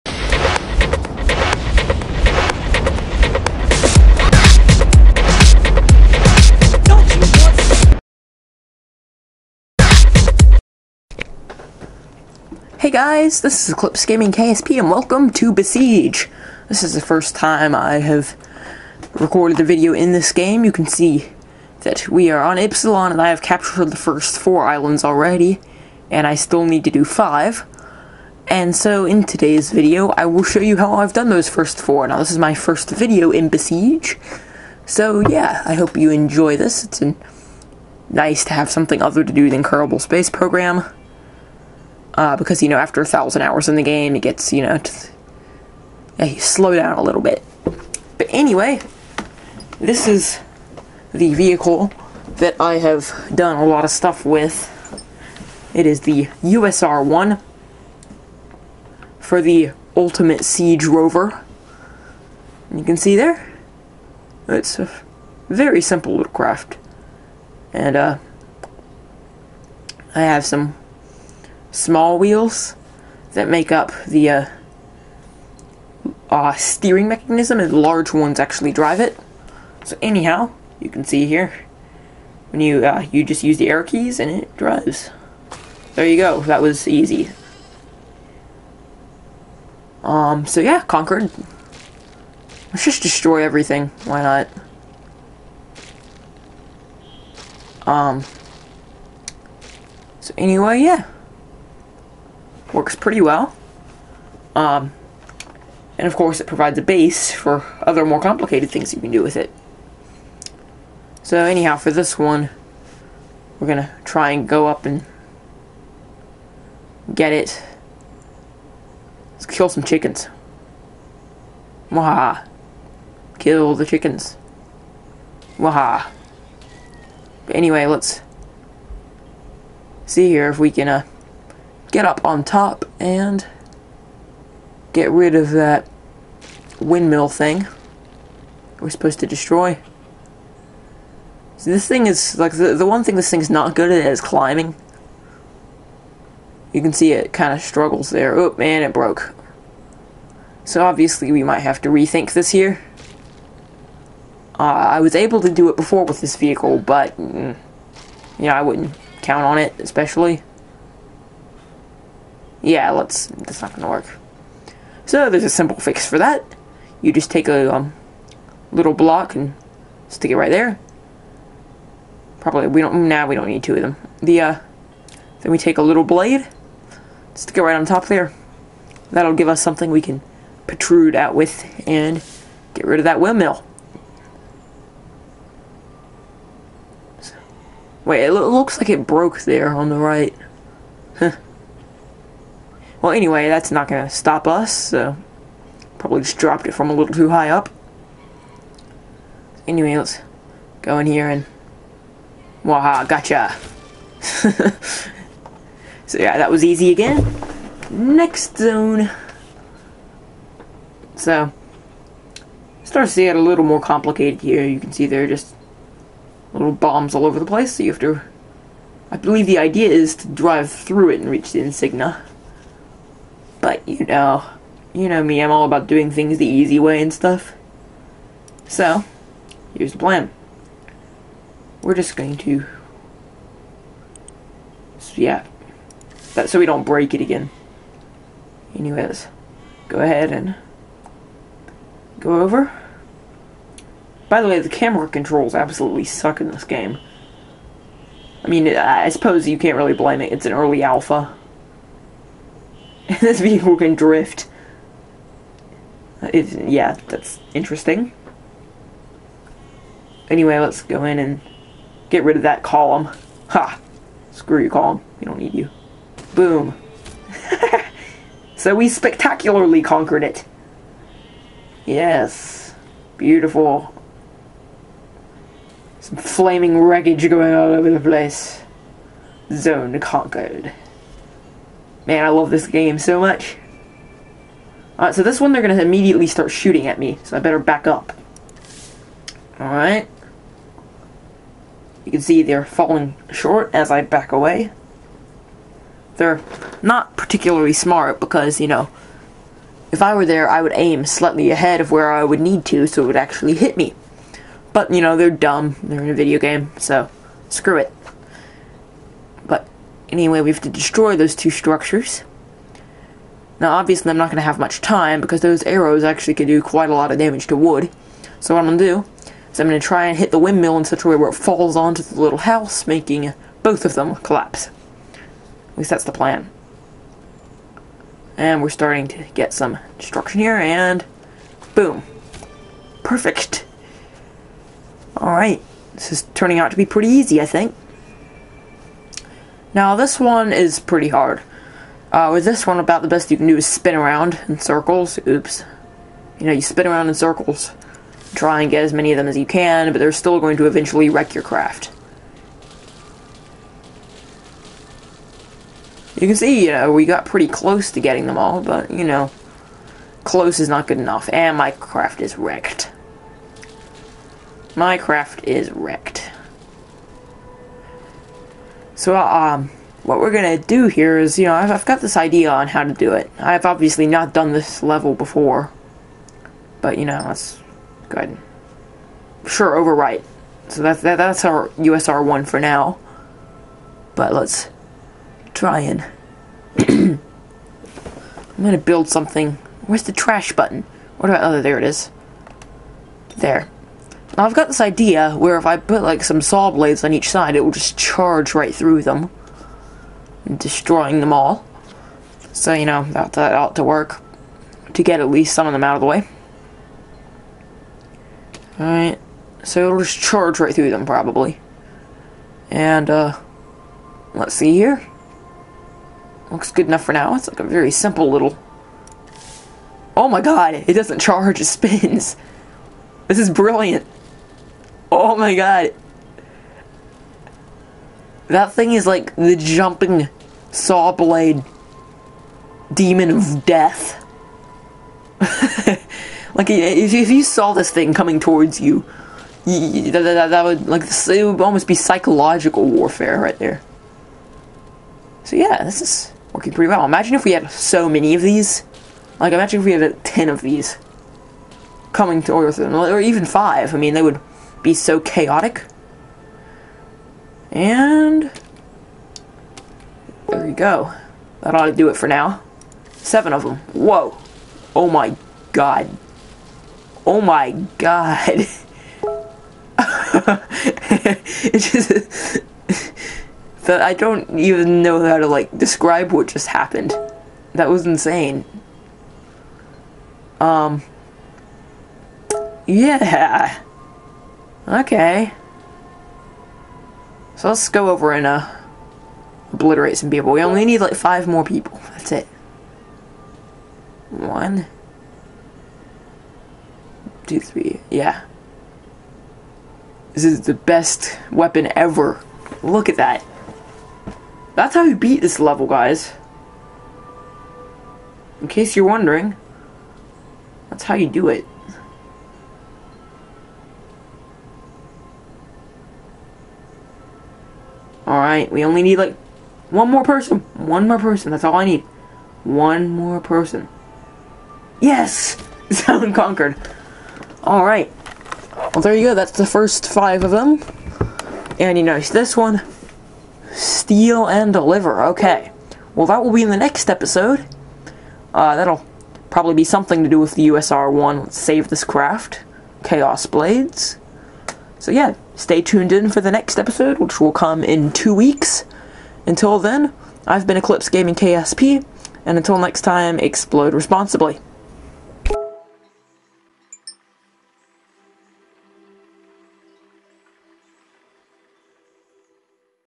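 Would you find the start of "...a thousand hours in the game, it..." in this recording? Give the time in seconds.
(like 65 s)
43 s.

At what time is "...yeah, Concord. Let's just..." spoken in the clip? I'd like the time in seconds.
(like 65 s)
90 s.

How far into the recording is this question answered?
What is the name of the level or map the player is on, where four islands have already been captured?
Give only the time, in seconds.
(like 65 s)
22 s.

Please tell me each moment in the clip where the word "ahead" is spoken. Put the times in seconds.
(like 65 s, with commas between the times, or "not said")
239 s, 301 s, 378 s.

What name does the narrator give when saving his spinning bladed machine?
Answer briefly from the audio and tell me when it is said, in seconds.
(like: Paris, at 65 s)
Chaos Blades, at 543 s.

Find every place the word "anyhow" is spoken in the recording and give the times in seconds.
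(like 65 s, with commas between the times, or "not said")
80 s, 111 s.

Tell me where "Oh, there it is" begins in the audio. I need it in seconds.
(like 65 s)
391 s.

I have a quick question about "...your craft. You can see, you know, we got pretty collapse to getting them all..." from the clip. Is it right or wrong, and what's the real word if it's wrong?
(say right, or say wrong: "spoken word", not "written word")
wrong: "close", not "collapse".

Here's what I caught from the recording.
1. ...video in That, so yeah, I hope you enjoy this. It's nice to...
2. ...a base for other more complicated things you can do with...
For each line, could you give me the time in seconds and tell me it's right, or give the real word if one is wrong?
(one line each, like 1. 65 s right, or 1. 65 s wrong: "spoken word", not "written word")
1. 32 s wrong: "Besiege", not "That"
2. 106 s right.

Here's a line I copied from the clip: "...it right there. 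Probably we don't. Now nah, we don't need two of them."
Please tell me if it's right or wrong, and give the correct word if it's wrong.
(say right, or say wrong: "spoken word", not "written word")
right.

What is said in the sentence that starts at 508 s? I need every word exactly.
In case you're wondering, that's how you do it.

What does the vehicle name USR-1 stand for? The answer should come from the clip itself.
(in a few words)
Ultimate Siege Rover.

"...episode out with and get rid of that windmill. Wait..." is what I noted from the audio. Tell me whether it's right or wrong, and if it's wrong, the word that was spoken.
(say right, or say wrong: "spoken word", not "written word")
wrong: "protrude", not "episode".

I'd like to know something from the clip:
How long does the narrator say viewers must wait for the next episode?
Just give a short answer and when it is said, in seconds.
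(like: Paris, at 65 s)
two weeks, at 548 s.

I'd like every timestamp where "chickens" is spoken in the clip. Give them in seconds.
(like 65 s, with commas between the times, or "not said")
119 s, 123 s.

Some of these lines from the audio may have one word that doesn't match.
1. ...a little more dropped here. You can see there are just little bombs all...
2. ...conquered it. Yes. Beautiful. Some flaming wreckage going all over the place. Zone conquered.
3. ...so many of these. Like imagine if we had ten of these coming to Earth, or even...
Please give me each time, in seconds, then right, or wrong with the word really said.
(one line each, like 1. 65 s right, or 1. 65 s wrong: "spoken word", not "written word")
1. 213 s wrong: "complicated", not "dropped"
2. 269 s right
3. 447 s right.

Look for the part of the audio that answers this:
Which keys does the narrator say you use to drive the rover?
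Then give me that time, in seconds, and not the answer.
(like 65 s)
83 s.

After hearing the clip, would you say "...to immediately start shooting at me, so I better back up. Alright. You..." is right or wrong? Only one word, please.
right.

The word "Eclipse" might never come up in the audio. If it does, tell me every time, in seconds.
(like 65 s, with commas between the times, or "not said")
13 s, 550 s.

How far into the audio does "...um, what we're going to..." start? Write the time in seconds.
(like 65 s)
369 s.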